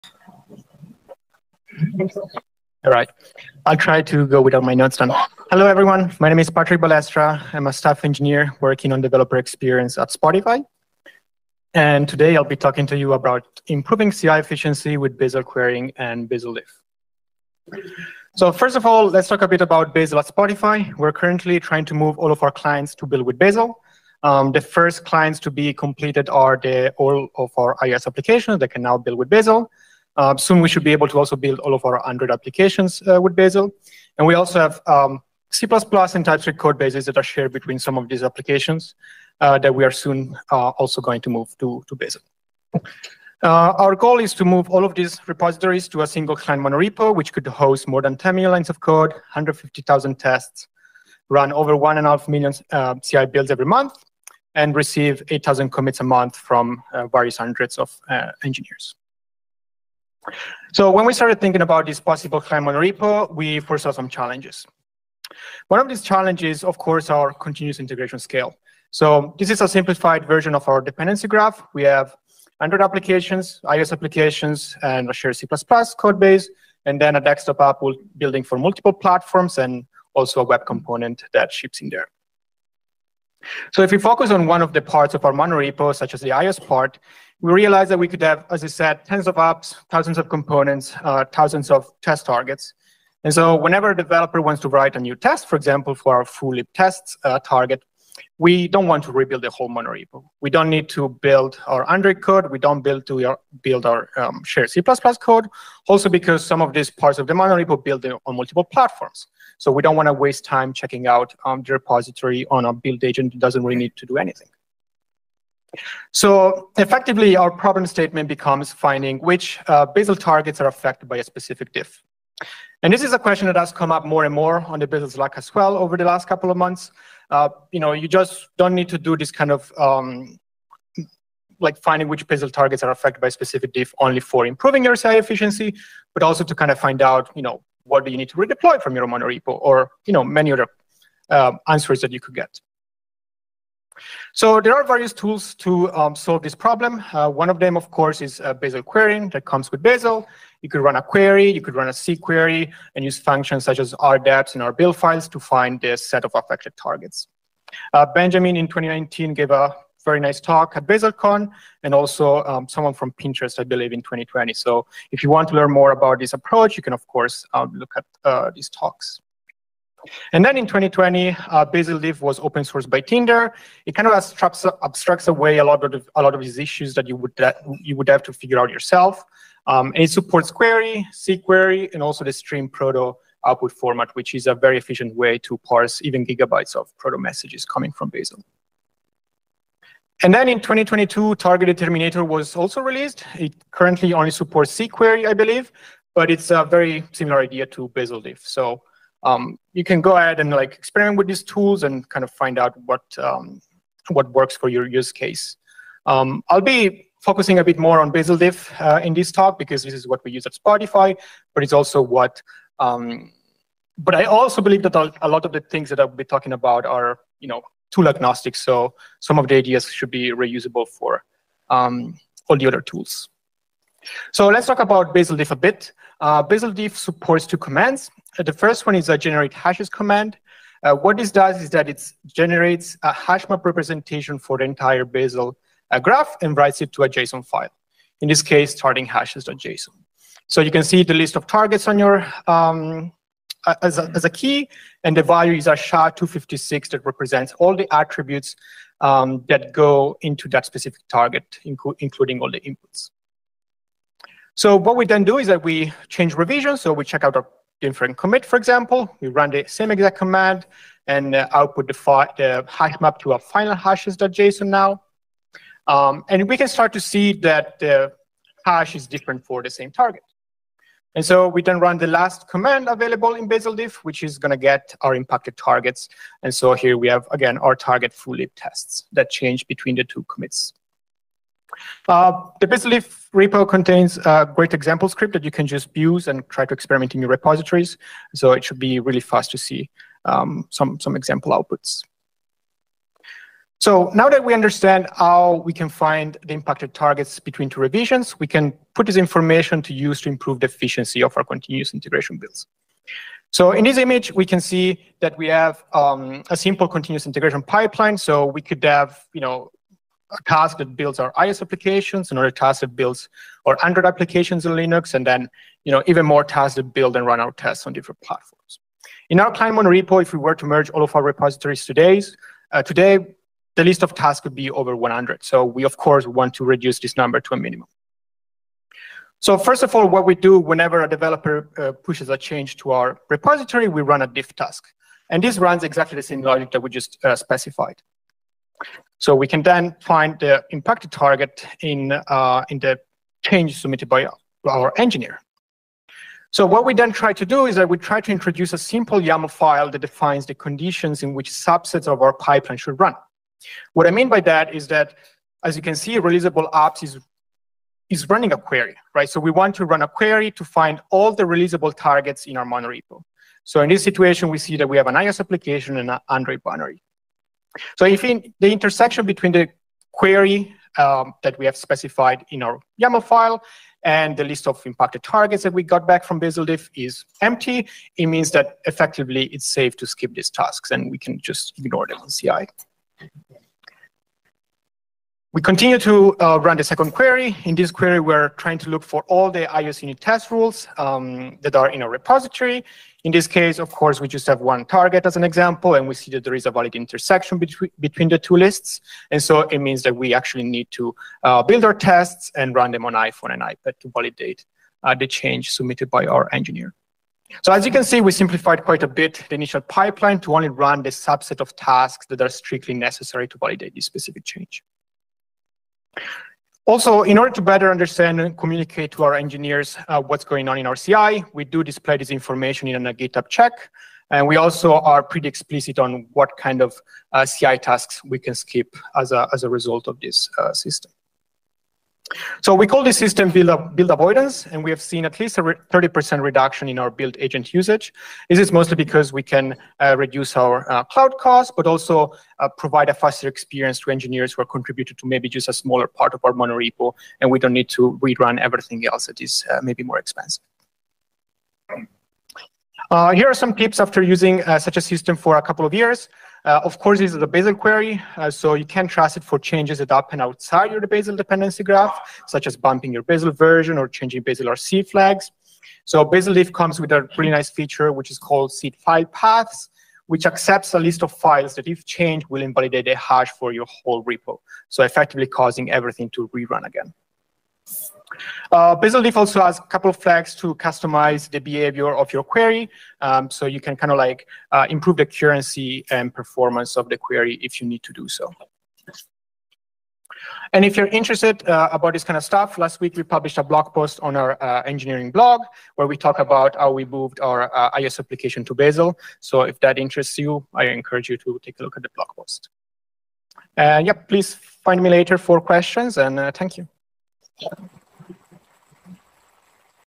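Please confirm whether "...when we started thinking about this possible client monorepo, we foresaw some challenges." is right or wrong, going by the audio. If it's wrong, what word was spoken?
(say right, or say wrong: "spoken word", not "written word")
right.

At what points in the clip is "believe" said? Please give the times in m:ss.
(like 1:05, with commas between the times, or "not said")
2:43, 3:15, 3:34.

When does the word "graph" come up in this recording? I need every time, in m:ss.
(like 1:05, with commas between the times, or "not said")
1:11, 3:55, 7:41.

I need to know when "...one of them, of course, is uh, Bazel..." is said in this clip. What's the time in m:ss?
2:27.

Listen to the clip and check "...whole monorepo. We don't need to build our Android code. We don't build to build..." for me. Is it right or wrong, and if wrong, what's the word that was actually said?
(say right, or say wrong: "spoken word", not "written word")
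right.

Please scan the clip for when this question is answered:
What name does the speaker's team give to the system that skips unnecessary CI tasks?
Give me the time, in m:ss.
7:13.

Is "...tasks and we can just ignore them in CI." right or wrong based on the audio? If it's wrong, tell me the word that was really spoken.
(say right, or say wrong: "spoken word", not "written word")
right.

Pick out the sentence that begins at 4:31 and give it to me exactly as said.
And so we then run the last command available in bazel-diff, which is going to get our impacted targets.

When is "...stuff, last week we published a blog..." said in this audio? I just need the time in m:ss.
8:12.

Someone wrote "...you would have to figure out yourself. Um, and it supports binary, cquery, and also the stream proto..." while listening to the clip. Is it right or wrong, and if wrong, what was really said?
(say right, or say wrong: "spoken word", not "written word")
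wrong: "query", not "binary".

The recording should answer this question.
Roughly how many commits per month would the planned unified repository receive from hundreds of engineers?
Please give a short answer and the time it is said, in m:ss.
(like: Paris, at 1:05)
8,000, at 0:55.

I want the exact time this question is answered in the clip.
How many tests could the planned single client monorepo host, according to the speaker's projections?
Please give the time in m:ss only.
0:49.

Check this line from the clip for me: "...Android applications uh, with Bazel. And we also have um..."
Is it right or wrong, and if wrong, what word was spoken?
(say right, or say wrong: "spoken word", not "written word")
right.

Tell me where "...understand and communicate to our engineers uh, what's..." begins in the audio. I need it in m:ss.
6:57.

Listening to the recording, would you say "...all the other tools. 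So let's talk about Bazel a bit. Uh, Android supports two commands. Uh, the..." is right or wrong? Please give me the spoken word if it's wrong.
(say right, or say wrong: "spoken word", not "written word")
wrong: "Bazel", not "Android".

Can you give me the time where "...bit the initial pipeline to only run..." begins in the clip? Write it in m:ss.
6:49.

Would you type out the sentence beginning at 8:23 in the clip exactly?
And yeah, please find me later for questions and uh, thank you.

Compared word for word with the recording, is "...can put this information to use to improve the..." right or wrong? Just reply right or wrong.
right.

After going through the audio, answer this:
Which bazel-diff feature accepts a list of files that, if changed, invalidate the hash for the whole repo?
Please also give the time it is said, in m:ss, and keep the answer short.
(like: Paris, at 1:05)
Seed file paths, at 7:48.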